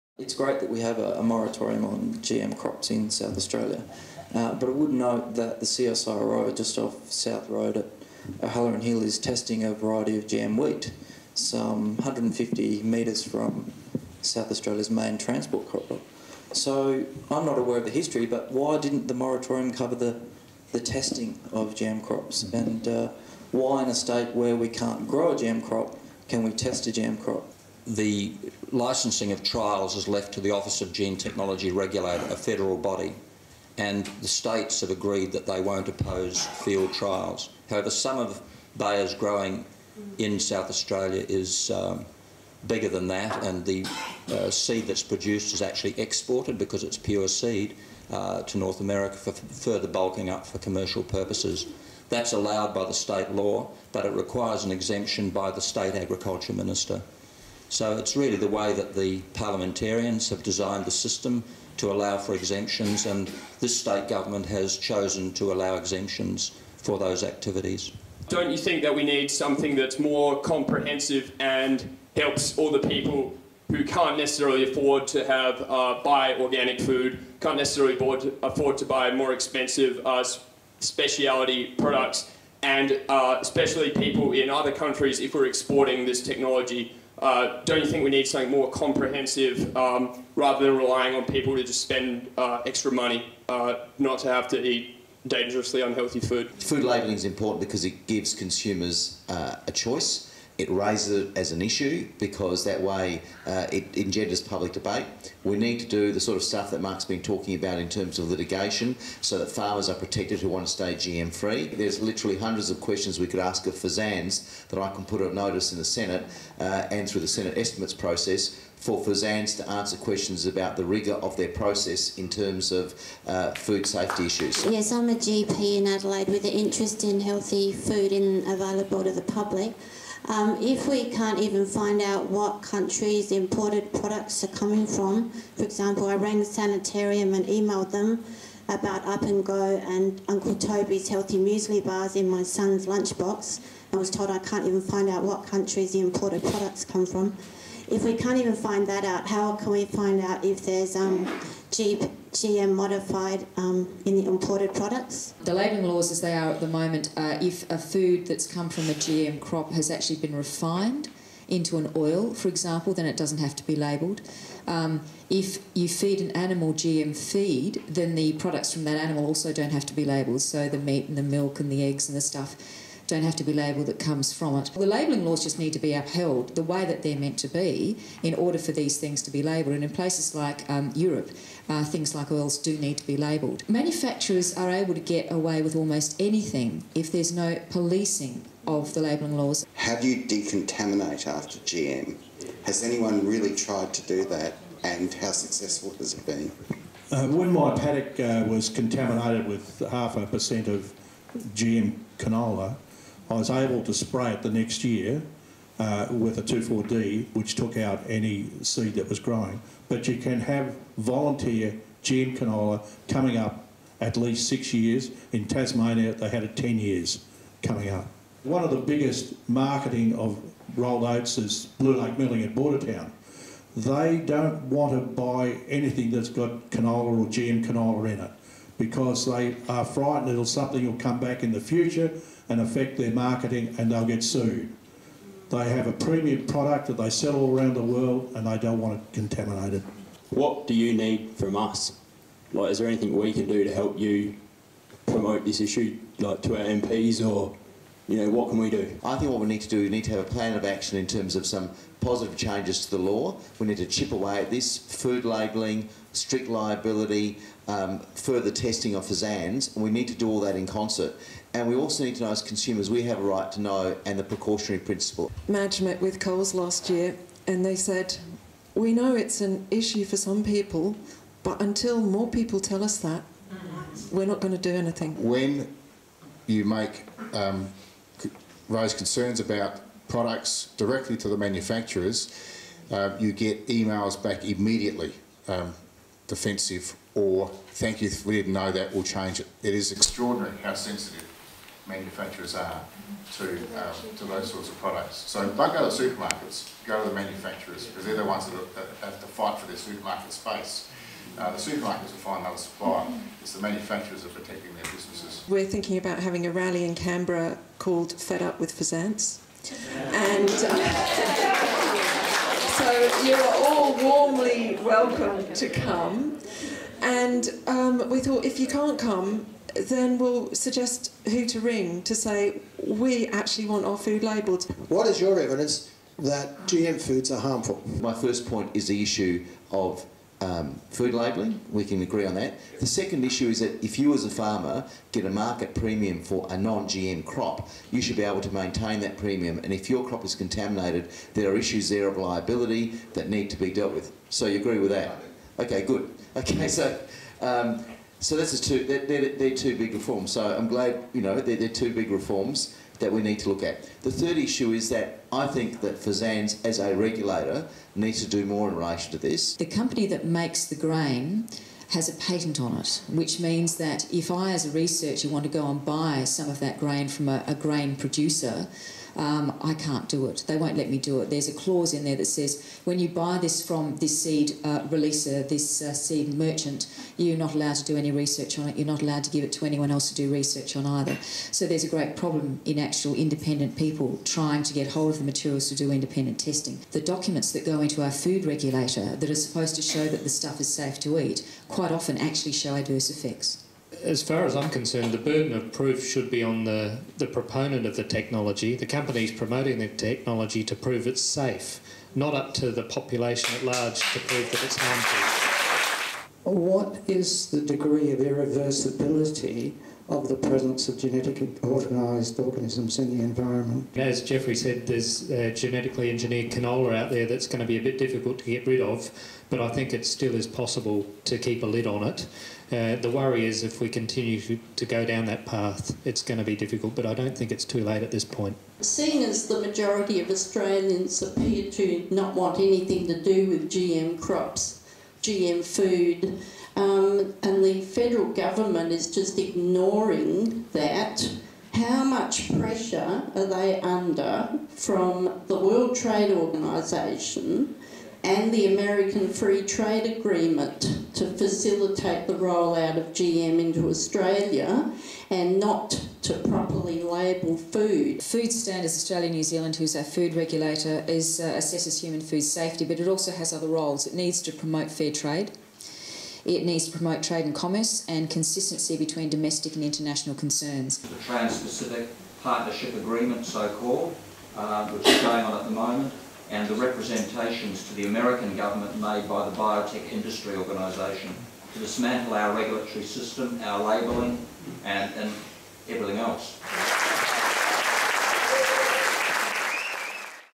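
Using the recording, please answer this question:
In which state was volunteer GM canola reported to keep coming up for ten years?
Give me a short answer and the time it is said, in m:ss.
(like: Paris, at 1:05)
Tasmania, at 3:35.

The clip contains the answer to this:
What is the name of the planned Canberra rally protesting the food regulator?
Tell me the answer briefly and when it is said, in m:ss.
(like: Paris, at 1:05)
Fed Up with FSANZ, at 5:08.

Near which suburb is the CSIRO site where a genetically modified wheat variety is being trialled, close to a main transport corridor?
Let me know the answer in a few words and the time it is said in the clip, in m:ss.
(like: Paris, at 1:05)
O'Halloran Hill, at 0:08.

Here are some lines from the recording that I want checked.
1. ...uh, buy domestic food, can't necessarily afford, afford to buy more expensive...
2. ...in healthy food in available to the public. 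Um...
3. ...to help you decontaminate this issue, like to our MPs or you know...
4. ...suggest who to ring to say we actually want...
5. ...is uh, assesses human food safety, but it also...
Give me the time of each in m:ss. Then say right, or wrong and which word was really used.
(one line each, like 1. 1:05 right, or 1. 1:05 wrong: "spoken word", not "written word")
1. 1:15 wrong: "organic", not "domestic"
2. 2:07 right
3. 4:03 wrong: "promote", not "decontaminate"
4. 5:20 right
5. 7:41 right.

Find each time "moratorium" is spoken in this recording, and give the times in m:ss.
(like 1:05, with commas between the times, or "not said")
0:01, 0:19.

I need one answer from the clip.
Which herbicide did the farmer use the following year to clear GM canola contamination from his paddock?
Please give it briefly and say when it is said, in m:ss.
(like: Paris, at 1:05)
2,4-D, at 3:26.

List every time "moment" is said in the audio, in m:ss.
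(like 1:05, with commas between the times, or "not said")
2:36, 7:55.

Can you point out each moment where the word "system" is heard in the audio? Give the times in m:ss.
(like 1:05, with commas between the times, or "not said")
1:00, 8:03.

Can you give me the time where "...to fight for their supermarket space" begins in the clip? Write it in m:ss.
4:59.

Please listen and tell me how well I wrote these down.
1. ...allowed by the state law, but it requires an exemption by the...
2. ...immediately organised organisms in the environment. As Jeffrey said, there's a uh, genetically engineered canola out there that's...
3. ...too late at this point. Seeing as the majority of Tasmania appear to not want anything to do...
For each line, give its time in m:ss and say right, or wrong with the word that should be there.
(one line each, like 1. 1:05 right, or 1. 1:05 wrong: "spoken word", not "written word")
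1. 0:52 right
2. 6:50 wrong: "genetically", not "immediately"
3. 7:07 wrong: "Australians", not "Tasmania".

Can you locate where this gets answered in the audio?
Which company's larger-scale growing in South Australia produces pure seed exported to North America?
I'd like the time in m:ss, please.
0:38.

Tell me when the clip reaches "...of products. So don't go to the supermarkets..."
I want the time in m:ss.
4:54.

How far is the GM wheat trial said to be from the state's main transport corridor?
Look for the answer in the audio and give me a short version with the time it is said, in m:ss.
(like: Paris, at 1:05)
150 metres, at 0:11.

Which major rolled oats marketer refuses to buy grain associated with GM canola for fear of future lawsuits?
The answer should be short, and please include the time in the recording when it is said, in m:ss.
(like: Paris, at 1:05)
Blue Lake Milling, at 3:41.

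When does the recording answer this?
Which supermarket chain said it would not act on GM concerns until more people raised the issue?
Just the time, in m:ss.
4:26.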